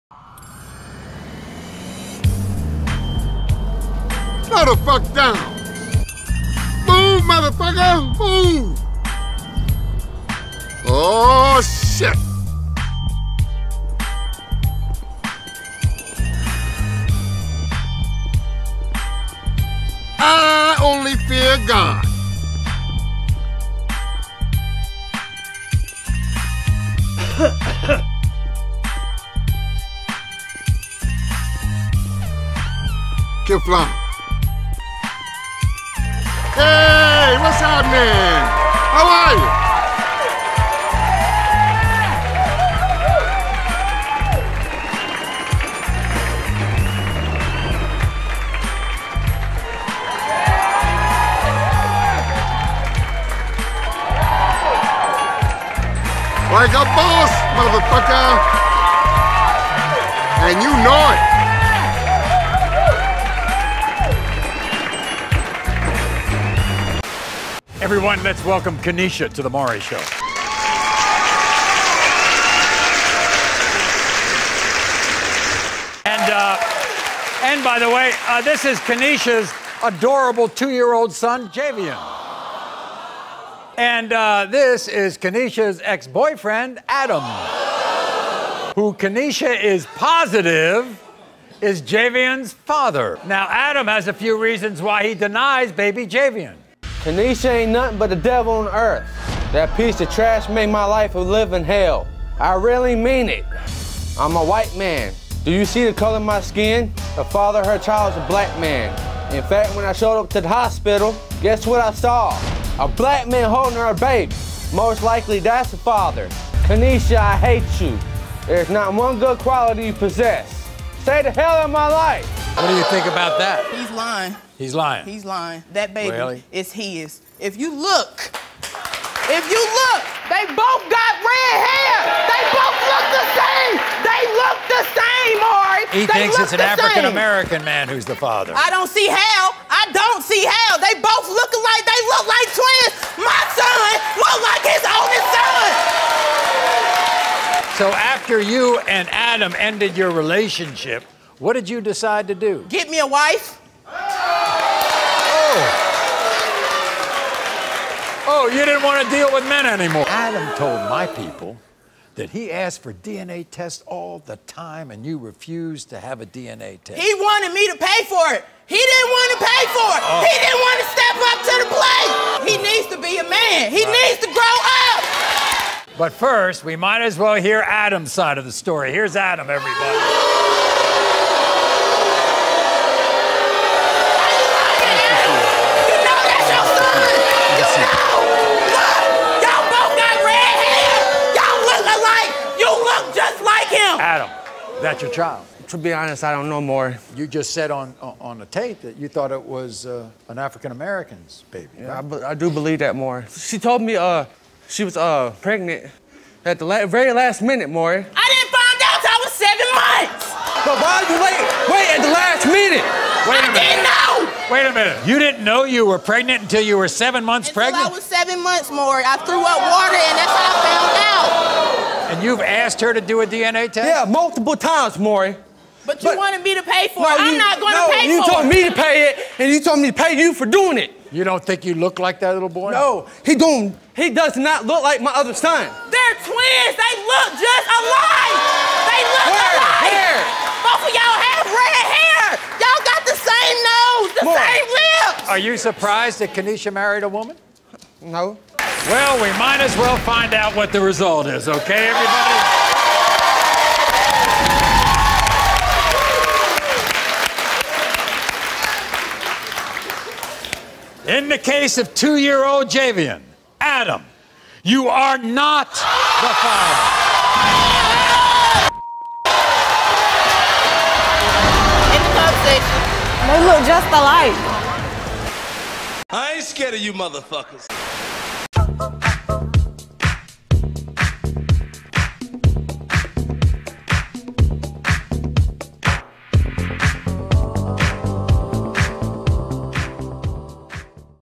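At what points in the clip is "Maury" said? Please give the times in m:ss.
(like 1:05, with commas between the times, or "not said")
1:09, 3:27, 3:38, 3:44.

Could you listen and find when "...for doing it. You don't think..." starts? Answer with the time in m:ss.
3:50.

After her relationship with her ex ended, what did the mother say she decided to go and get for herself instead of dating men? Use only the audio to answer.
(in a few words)
a wife.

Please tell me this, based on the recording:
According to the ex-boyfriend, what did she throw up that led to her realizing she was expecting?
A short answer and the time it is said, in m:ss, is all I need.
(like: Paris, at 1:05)
water, at 3:39.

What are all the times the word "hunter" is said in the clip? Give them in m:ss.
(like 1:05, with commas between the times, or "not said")
not said.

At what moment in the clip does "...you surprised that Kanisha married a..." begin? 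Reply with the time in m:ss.
4:05.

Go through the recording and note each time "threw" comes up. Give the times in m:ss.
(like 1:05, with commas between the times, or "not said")
3:39.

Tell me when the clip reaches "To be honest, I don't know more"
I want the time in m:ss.
3:15.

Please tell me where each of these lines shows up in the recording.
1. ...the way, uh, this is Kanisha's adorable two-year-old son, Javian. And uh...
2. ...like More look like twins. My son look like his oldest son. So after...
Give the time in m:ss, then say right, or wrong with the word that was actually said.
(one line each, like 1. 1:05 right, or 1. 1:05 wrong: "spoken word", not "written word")
1. 1:17 right
2. 2:21 wrong: "They", not "More".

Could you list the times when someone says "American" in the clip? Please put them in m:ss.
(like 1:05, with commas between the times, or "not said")
2:17, 3:20.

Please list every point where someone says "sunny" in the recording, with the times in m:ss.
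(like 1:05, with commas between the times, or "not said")
not said.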